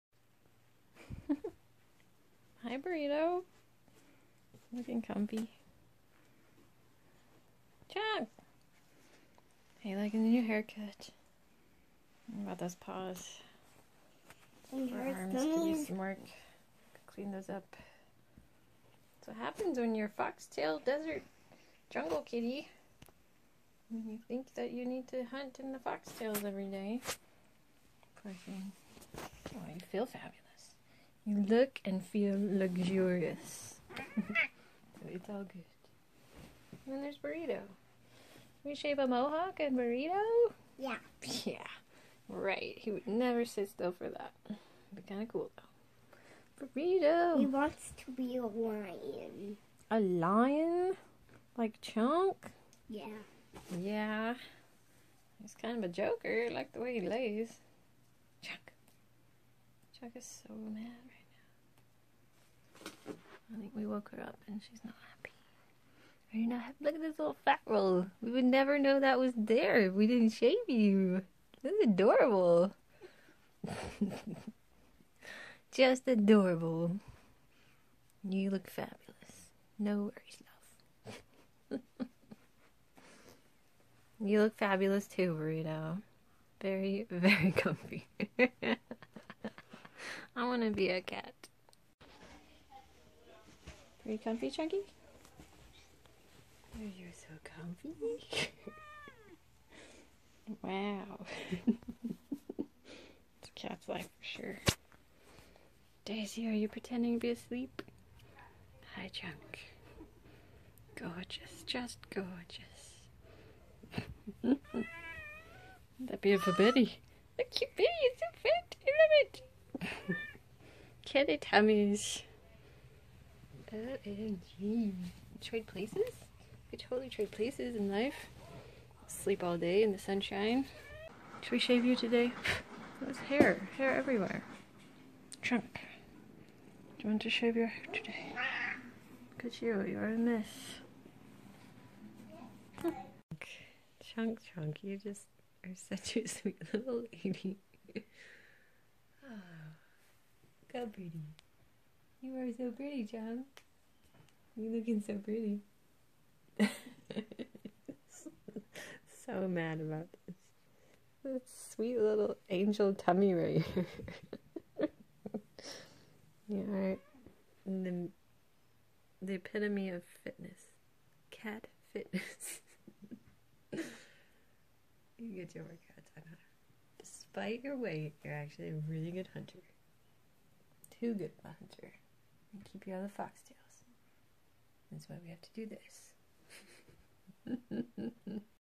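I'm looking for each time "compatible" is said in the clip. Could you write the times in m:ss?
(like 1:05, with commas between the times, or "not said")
not said.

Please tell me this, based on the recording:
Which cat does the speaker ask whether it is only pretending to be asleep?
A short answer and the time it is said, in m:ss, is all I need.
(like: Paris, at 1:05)
Daisy, at 1:46.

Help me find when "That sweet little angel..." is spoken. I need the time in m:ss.
2:41.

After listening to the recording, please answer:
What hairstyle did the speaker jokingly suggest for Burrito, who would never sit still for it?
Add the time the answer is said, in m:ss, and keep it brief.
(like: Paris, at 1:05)
mohawk, at 0:39.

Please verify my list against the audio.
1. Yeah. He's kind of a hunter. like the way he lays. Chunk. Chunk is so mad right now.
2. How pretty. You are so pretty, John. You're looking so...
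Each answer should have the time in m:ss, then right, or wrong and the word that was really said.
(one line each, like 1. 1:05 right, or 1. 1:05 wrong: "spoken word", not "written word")
1. 0:53 wrong: "joker", not "hunter"
2. 2:30 right.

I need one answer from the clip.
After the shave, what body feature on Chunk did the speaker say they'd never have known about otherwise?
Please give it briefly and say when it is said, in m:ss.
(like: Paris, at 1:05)
fat roll, at 1:07.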